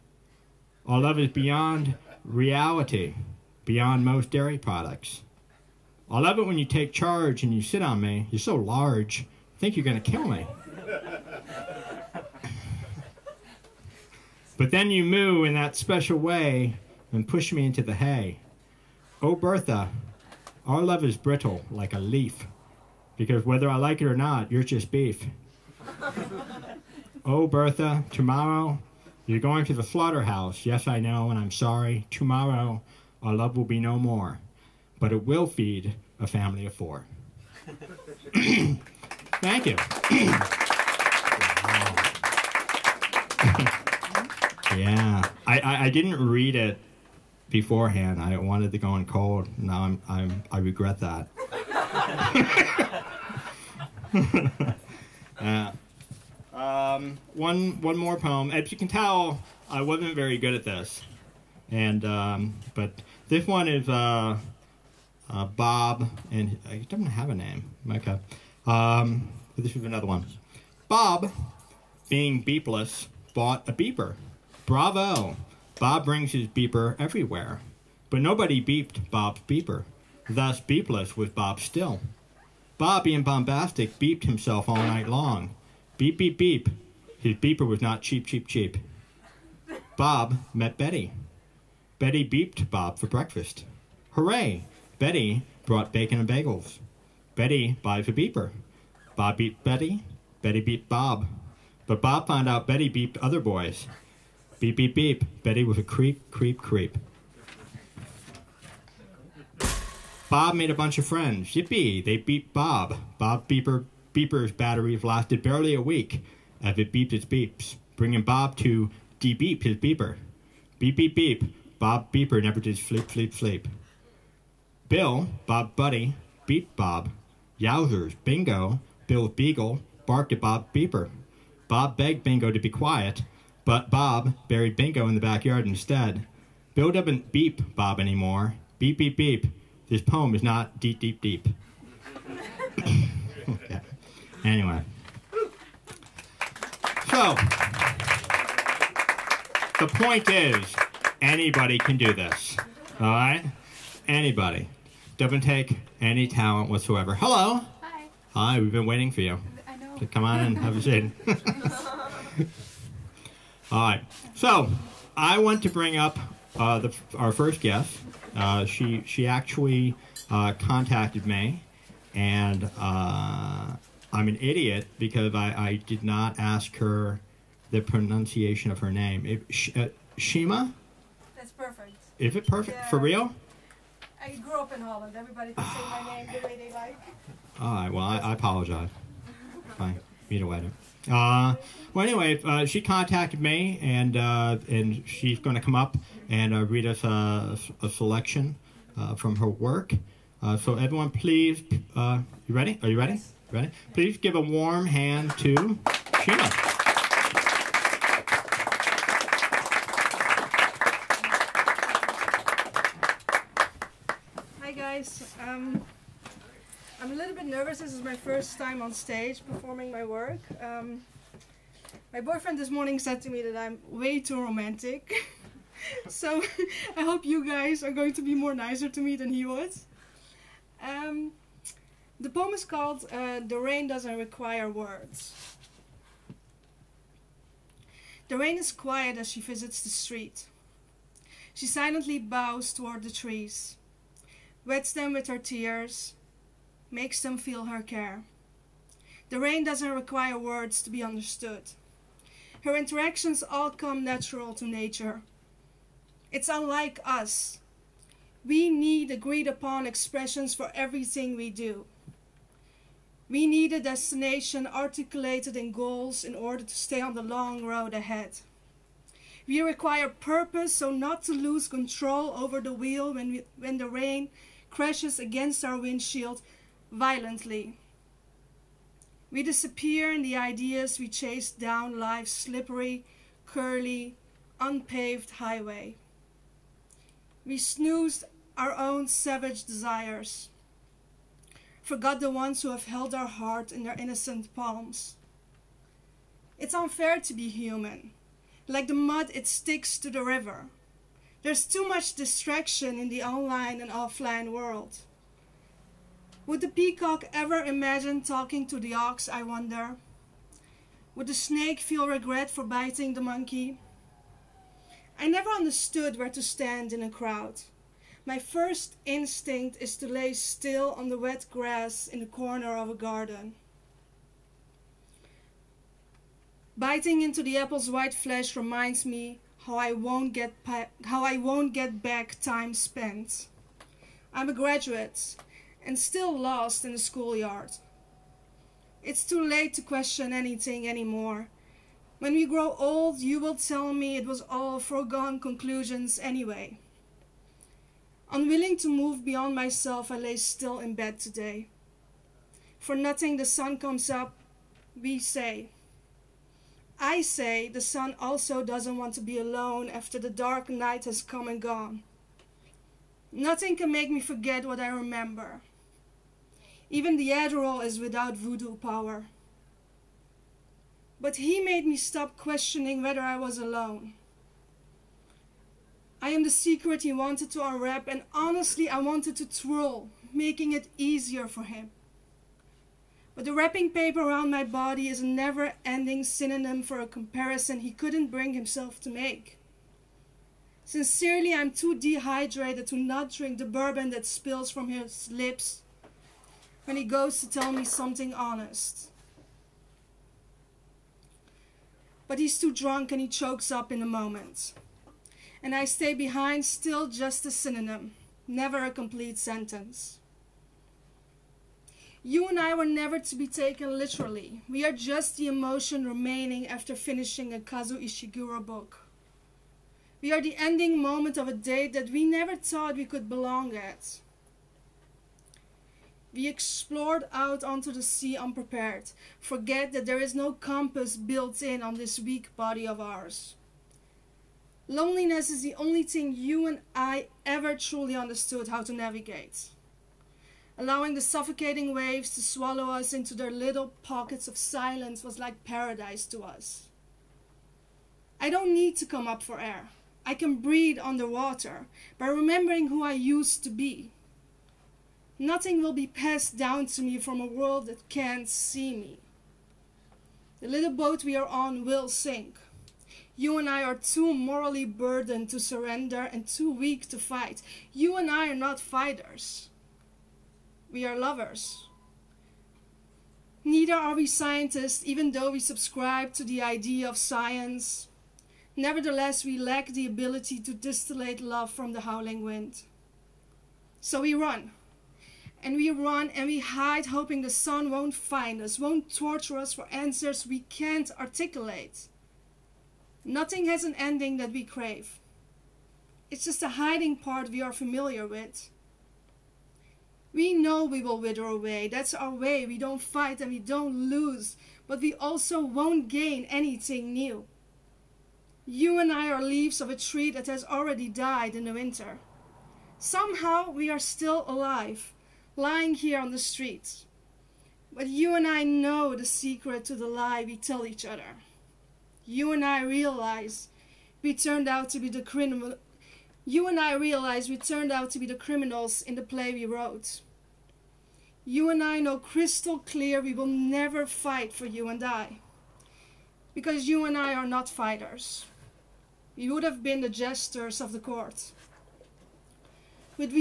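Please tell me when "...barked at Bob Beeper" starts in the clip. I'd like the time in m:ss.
2:10.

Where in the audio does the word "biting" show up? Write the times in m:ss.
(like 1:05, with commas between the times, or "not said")
5:12, 5:26.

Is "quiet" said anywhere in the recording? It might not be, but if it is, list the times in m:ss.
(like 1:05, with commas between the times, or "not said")
2:12, 3:58.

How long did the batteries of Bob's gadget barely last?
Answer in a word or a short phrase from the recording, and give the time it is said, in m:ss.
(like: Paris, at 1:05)
a week, at 1:55.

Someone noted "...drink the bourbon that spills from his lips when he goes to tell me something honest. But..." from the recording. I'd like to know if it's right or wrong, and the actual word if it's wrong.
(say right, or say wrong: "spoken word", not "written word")
right.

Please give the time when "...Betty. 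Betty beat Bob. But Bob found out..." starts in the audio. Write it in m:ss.
1:39.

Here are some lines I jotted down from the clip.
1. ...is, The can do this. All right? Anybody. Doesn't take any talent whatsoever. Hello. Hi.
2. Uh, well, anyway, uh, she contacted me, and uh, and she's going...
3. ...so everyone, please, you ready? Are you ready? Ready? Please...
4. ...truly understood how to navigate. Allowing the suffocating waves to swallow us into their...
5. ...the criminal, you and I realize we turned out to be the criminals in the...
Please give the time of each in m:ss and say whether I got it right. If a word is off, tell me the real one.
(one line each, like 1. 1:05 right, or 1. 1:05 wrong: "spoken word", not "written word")
1. 2:30 wrong: "Anybody", not "The"
2. 3:11 right
3. 3:20 right
4. 7:17 right
5. 8:45 right.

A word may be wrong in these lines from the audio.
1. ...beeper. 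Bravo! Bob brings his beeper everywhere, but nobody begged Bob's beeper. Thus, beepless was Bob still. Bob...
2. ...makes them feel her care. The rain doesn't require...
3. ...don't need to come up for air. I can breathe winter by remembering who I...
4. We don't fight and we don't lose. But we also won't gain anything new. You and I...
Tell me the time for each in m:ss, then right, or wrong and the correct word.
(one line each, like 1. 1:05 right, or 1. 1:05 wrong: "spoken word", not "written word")
1. 1:13 wrong: "beeped", not "begged"
2. 4:06 right
3. 7:28 wrong: "underwater", not "winter"
4. 8:22 right.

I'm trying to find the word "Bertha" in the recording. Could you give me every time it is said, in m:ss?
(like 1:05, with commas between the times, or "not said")
0:19, 0:27.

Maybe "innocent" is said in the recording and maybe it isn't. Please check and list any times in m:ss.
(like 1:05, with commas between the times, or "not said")
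4:53.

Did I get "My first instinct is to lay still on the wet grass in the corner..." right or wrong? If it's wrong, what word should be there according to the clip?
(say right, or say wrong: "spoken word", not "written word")
right.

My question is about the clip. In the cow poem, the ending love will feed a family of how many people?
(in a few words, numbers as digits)
4.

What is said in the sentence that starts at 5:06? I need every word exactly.
Would the peacock ever imagine talking to the ox, I wonder?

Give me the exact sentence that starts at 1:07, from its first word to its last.
Okay, um, but this is another one.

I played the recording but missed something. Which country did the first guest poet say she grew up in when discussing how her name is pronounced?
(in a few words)
Holland.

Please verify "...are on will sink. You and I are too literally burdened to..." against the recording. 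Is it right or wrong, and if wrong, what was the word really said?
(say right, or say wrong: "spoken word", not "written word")
wrong: "morally", not "literally".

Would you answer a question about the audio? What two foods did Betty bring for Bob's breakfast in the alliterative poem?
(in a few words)
bacon and bagels.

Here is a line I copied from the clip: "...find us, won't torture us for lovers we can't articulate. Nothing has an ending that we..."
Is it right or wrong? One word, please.
wrong.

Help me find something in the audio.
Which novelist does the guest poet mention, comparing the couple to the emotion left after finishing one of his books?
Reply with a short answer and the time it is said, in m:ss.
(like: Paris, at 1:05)
Kazuo Ishiguro, at 6:57.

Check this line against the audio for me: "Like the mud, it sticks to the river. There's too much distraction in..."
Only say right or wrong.
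right.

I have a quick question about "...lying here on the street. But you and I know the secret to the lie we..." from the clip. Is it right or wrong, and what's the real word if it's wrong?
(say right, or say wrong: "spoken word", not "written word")
right.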